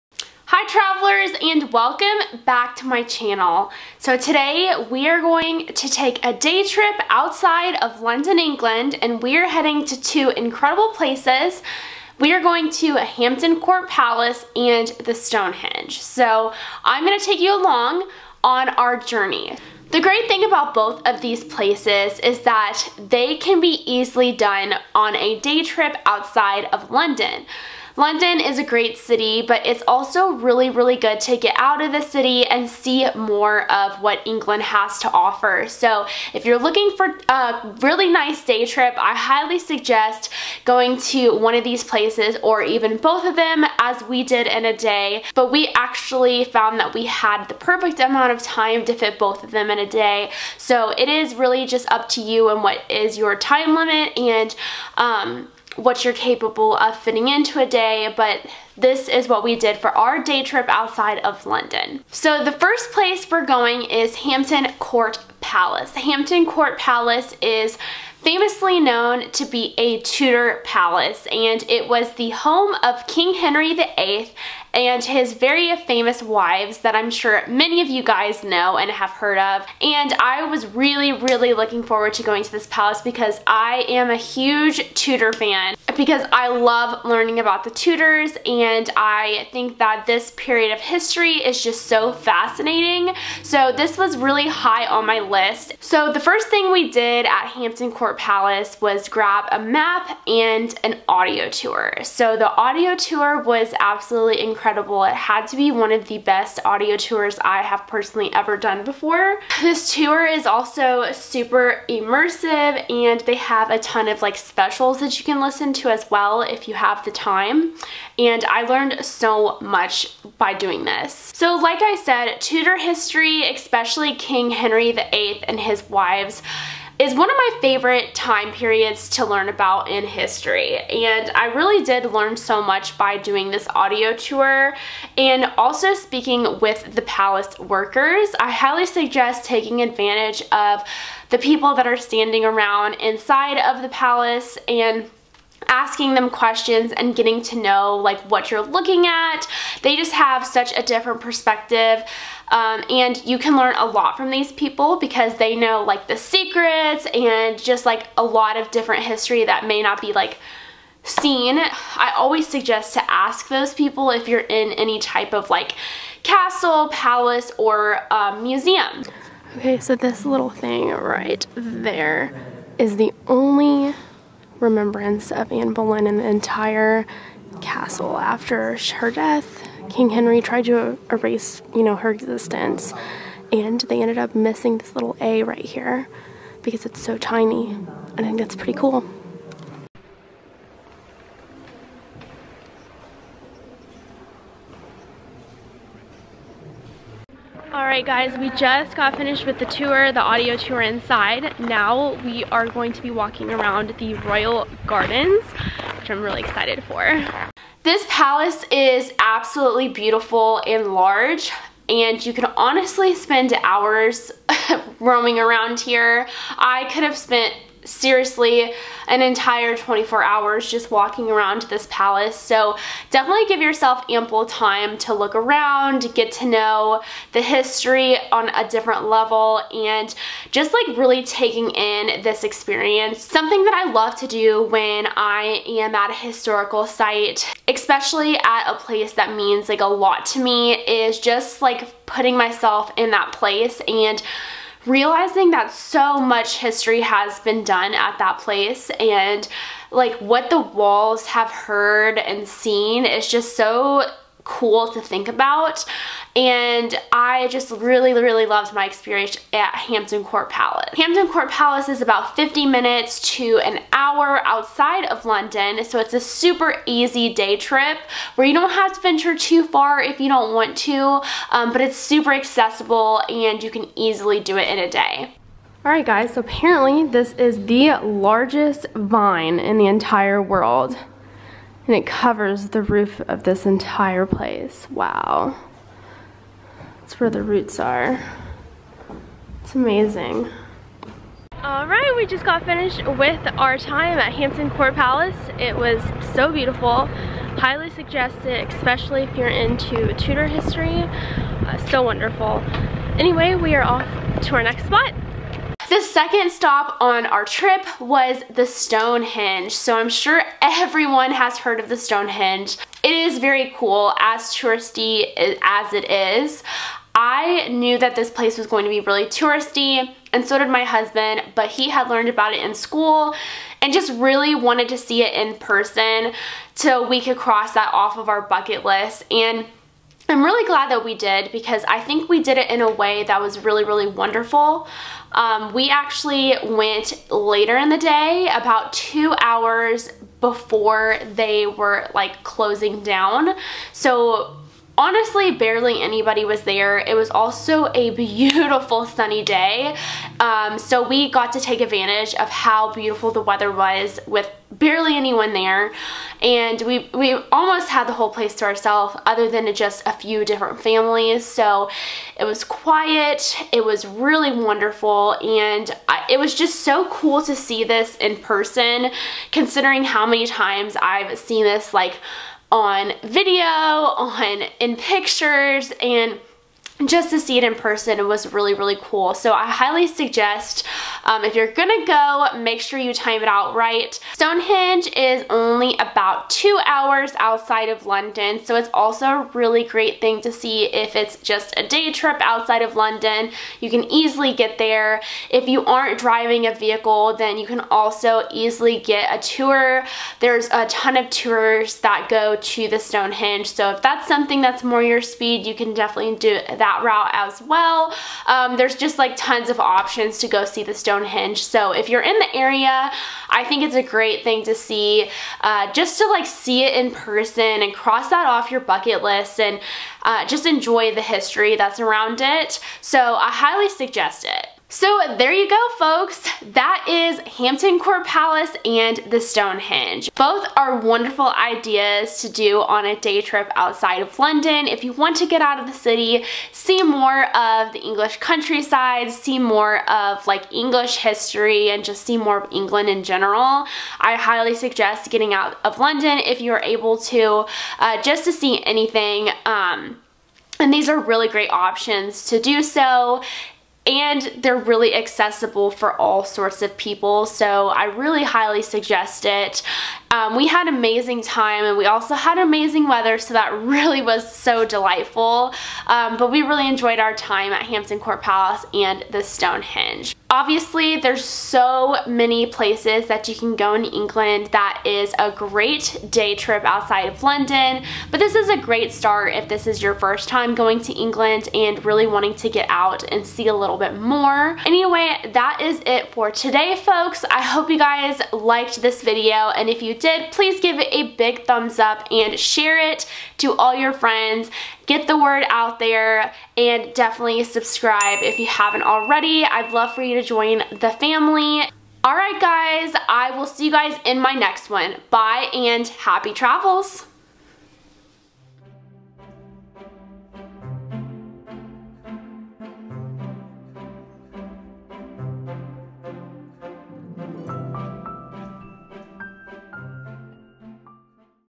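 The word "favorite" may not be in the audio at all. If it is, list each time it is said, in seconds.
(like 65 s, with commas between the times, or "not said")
127 s.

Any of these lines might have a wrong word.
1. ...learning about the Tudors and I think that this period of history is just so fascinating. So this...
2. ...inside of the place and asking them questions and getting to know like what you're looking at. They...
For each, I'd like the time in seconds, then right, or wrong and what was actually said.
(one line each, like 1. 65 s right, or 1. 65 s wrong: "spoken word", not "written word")
1. 87 s right
2. 142 s wrong: "palace", not "place".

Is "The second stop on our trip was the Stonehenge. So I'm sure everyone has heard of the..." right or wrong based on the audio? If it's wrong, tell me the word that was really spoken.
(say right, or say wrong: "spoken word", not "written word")
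right.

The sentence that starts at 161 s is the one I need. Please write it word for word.
I always suggest to ask those people if you're in any type of like castle, palace, or um, museum.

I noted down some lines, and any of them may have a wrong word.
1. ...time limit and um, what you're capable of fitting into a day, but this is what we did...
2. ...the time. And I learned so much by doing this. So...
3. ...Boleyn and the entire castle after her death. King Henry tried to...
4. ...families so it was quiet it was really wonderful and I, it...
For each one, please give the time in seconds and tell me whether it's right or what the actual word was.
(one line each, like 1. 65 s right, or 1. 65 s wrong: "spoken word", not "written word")
1. 53 s right
2. 117 s right
3. 175 s right
4. 360 s right.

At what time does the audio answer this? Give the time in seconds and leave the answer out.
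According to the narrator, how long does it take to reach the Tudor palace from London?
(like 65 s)
262 s.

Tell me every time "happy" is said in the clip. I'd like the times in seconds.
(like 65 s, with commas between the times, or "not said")
506 s.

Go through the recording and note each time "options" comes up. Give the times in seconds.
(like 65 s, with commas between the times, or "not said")
409 s, 451 s.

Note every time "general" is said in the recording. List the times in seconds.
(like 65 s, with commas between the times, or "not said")
443 s.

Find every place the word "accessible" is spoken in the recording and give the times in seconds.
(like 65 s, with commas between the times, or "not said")
272 s, 455 s.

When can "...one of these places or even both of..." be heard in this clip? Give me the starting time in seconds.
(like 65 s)
41 s.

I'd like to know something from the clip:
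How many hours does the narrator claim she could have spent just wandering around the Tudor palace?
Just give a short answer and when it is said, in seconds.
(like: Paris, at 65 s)
24, at 219 s.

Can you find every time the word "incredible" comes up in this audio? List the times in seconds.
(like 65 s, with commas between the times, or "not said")
10 s, 104 s.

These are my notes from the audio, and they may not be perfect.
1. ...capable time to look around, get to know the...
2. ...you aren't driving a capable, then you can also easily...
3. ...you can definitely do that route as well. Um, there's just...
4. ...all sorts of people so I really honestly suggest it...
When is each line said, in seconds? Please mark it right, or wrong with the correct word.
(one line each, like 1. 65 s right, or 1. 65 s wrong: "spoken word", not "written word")
1. 224 s wrong: "ample", not "capable"
2. 395 s wrong: "vehicle", not "capable"
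3. 405 s right
4. 456 s wrong: "highly", not "honestly".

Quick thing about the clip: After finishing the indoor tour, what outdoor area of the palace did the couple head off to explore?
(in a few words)
The Royal Gardens.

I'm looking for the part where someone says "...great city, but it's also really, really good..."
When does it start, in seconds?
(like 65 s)
28 s.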